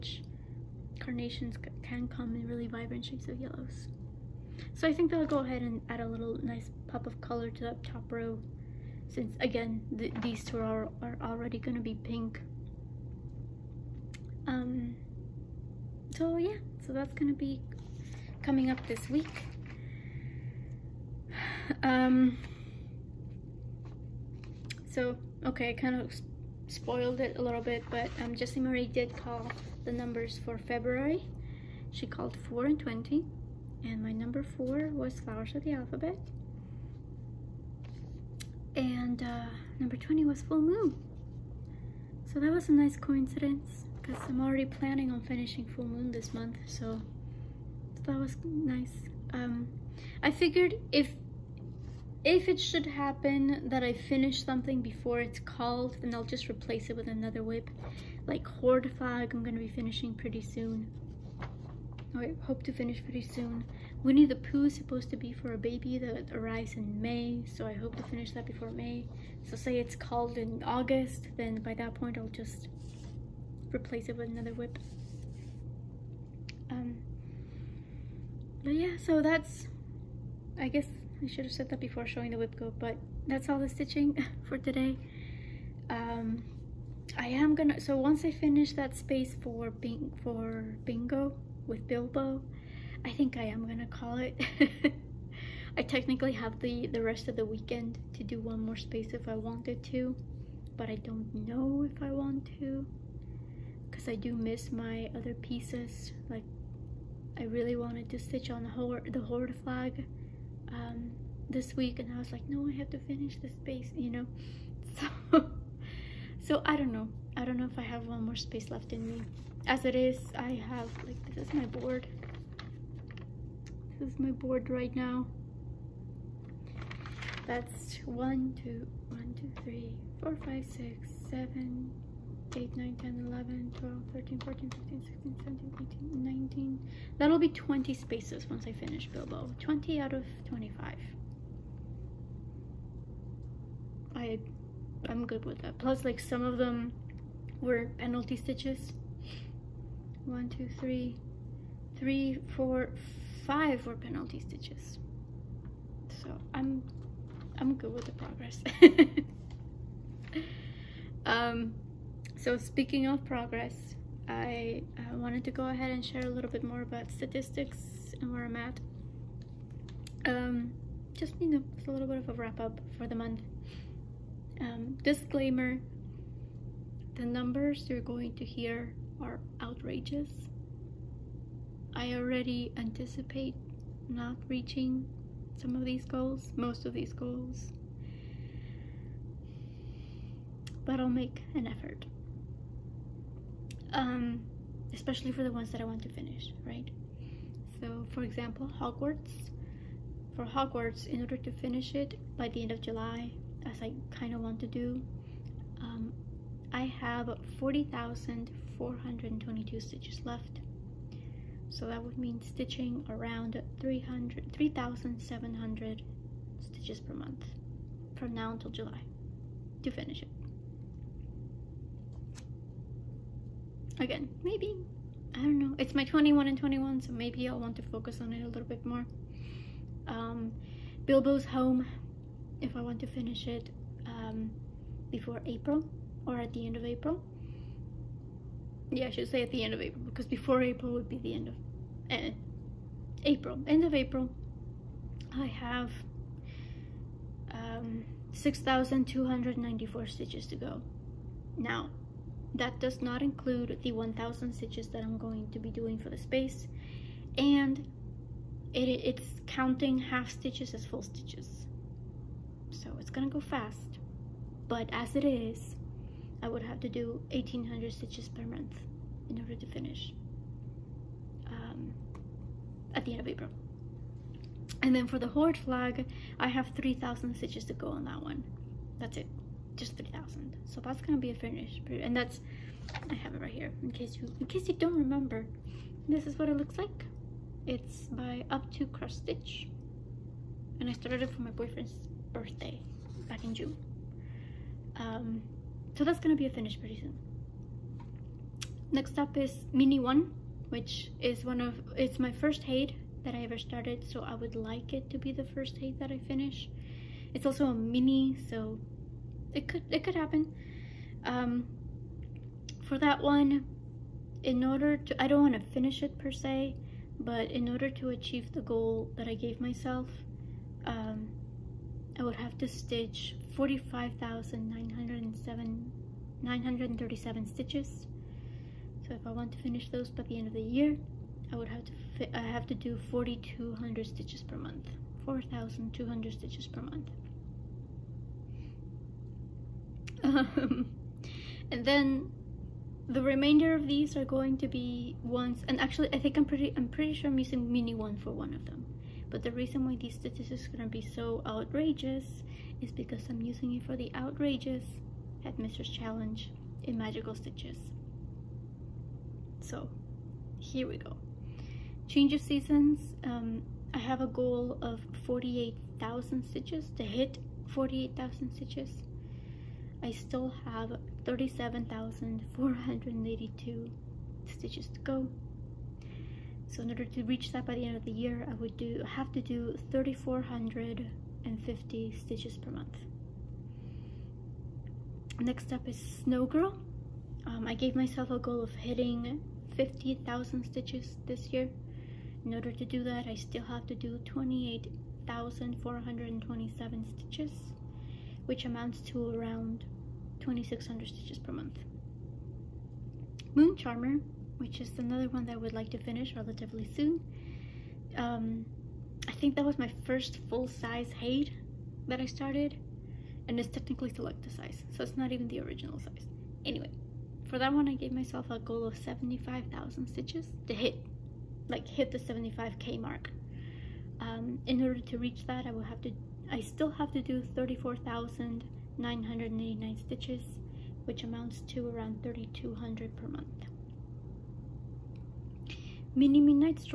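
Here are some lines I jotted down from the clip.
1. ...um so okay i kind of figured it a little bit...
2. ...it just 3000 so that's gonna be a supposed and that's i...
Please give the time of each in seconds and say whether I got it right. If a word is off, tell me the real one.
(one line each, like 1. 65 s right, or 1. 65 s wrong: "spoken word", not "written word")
1. 21 s wrong: "spoiled", not "figured"
2. 279 s wrong: "finished", not "supposed".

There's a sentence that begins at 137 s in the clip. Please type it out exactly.
That'll be 20 spaces once I finish Bilbo.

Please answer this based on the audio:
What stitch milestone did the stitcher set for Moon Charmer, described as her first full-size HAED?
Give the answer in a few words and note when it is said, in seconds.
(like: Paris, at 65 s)
75,000, at 418 s.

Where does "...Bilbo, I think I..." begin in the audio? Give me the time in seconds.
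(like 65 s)
91 s.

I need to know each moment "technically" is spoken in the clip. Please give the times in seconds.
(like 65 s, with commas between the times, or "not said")
95 s, 413 s.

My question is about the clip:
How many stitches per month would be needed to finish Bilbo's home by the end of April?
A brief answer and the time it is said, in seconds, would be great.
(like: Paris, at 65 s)
1800, at 267 s.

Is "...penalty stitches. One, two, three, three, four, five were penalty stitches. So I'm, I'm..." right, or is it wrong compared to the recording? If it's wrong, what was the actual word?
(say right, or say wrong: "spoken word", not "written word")
right.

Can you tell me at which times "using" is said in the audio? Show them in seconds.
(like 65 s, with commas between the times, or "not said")
347 s, 353 s.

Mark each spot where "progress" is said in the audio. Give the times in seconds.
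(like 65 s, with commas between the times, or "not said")
158 s, 163 s.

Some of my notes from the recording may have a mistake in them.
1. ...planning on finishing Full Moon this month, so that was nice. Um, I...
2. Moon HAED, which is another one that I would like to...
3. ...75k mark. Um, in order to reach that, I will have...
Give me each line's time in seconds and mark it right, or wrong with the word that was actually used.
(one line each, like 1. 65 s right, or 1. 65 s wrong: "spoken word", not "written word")
1. 44 s right
2. 403 s wrong: "Charmer", not "HAED"
3. 422 s right.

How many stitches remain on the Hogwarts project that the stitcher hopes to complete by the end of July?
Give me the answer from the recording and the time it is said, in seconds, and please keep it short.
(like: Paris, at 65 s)
40,422, at 207 s.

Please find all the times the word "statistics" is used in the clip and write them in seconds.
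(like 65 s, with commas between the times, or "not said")
167 s, 350 s.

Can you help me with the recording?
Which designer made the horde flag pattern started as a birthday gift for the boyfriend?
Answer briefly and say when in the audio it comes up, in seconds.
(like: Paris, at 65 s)
Up to Cross Stitch, at 288 s.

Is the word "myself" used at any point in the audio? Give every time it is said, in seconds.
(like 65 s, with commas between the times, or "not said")
319 s, 387 s, 418 s.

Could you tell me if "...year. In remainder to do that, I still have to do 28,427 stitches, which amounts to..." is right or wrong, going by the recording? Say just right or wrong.
wrong.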